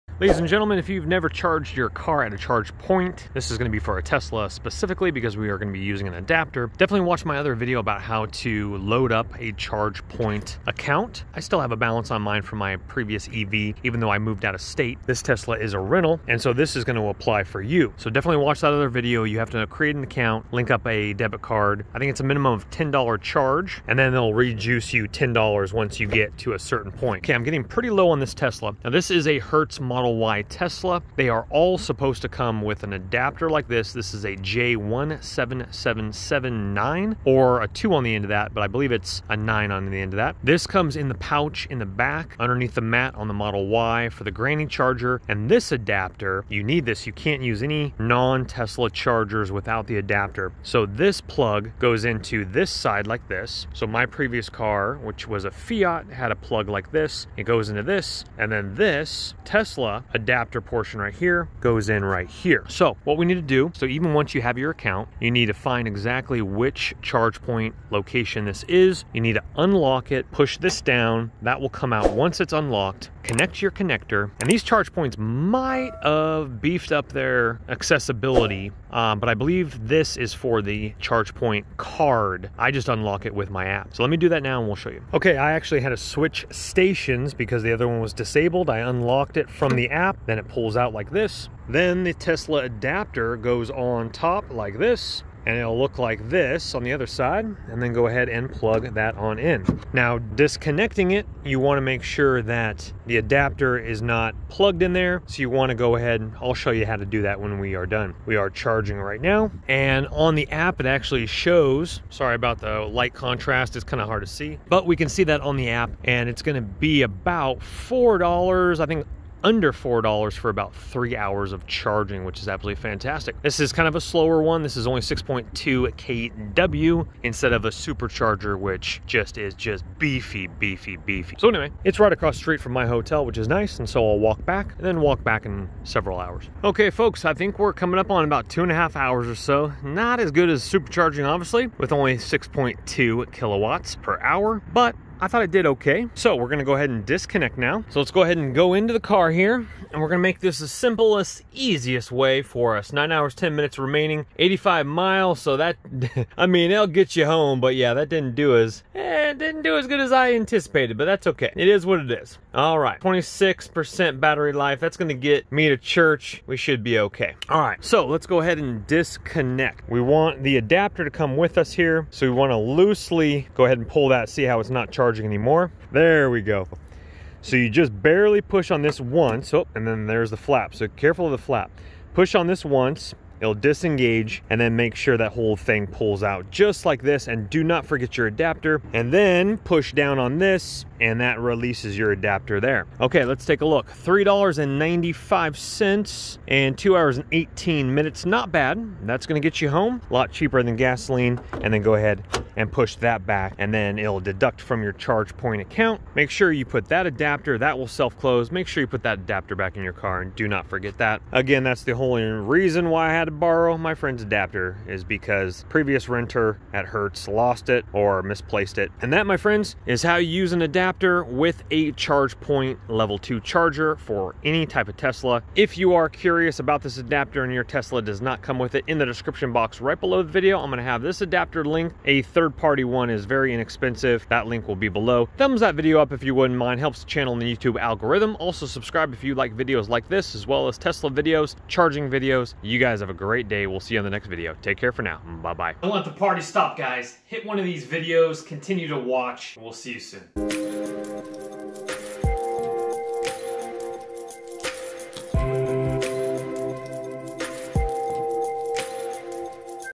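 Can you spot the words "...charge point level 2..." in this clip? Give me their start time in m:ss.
3:41.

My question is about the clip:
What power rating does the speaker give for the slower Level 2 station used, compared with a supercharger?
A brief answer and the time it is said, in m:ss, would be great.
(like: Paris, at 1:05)
6.2 kW, at 2:05.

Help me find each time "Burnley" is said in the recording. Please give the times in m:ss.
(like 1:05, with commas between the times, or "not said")
not said.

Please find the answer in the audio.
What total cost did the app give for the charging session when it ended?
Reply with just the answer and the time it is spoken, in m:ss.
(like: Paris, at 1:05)
$3.95, at 3:13.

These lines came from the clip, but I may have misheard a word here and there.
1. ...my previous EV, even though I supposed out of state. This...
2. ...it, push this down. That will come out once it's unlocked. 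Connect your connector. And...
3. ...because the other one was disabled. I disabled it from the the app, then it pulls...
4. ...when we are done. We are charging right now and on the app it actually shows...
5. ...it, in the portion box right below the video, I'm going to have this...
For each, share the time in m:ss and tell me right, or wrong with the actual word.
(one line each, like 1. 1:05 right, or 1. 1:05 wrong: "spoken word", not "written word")
1. 0:12 wrong: "moved", not "supposed"
2. 1:10 right
3. 1:27 wrong: "unlocked", not "disabled"
4. 1:47 right
5. 3:48 wrong: "description", not "portion".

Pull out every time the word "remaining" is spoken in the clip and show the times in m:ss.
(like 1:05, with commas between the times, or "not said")
2:33.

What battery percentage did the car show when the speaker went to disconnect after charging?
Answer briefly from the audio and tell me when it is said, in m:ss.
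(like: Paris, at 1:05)
26%, at 2:42.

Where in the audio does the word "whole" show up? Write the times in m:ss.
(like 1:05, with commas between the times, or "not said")
3:05, 3:31.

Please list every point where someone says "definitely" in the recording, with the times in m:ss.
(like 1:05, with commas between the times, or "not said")
0:06, 0:18.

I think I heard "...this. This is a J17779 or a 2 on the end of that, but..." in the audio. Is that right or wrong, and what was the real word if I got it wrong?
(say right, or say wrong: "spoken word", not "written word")
right.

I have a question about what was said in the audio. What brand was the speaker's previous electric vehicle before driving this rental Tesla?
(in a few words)
Fiat.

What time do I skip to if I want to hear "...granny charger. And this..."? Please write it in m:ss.
0:44.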